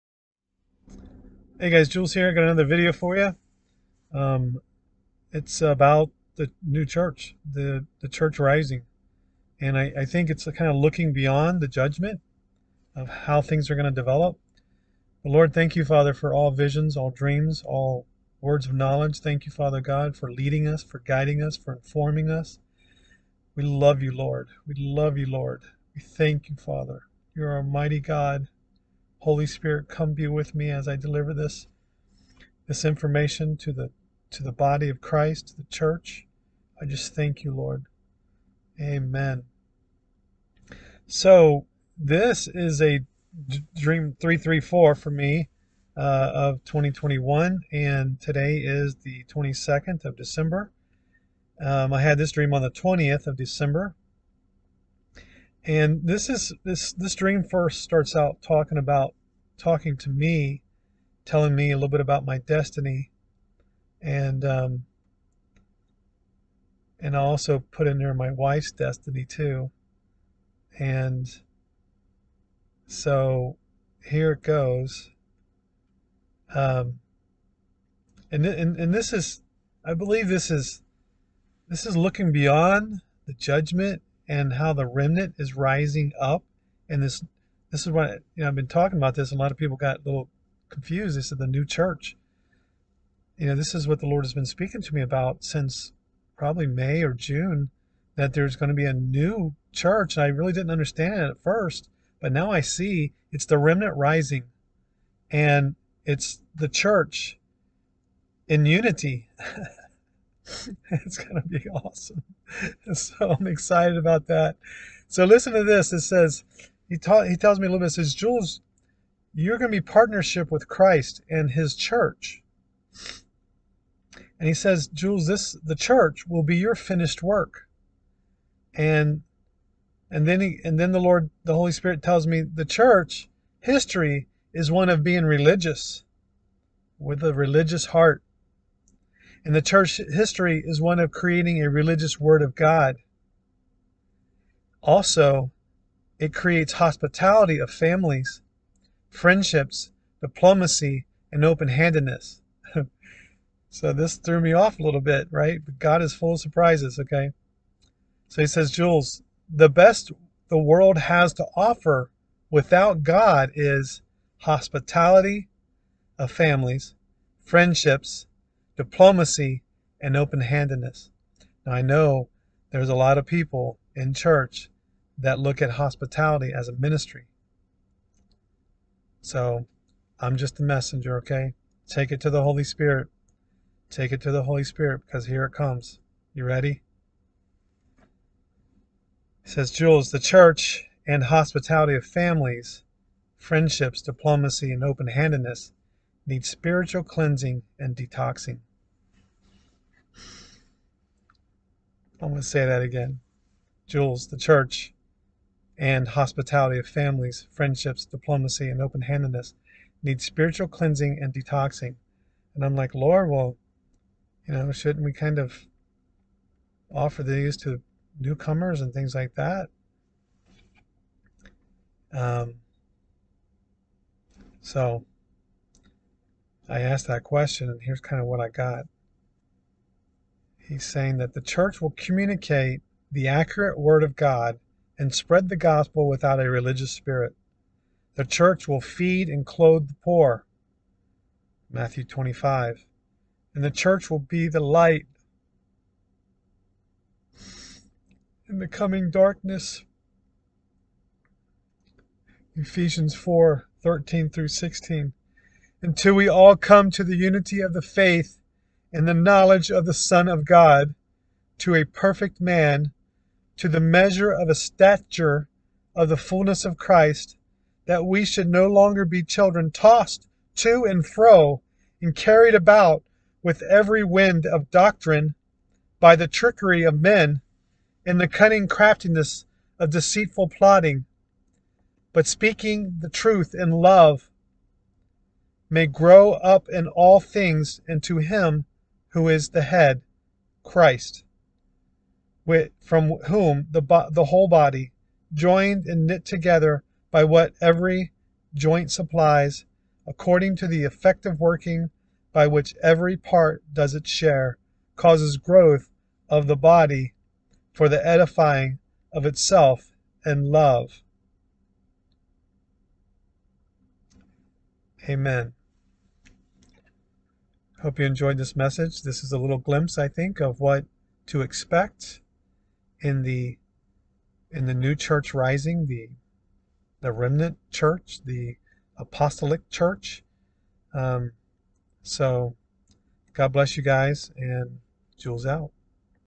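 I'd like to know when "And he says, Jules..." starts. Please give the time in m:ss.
2:04.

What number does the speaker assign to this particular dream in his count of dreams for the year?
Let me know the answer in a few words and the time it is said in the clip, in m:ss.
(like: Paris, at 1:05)
334, at 0:44.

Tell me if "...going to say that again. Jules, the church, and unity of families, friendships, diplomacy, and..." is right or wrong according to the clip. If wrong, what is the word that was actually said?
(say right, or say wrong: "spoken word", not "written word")
wrong: "hospitality", not "unity".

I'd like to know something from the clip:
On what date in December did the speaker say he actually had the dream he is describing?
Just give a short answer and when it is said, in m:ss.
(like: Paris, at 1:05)
20th of December, at 0:52.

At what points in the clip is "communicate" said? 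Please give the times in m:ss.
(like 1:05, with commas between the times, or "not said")
3:51.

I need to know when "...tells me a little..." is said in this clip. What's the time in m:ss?
1:57.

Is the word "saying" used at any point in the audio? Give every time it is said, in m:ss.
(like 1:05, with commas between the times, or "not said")
3:50.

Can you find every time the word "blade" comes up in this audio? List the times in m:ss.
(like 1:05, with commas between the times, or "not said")
not said.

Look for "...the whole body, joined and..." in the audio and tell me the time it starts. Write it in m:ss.
4:54.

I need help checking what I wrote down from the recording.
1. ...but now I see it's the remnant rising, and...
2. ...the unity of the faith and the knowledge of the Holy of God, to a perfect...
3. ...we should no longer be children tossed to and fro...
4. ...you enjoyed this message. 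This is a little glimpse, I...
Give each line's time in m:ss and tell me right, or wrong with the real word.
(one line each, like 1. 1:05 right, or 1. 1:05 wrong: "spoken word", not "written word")
1. 1:42 right
2. 4:17 wrong: "Son", not "Holy"
3. 4:28 right
4. 5:17 right.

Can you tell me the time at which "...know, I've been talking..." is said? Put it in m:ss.
1:28.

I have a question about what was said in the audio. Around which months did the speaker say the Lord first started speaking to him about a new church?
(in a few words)
May or June.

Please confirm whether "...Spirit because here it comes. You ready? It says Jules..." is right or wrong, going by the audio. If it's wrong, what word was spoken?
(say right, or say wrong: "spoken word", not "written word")
right.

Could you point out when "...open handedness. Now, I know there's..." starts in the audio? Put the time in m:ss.
2:50.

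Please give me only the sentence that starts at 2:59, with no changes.
So I'm just a messenger, okay?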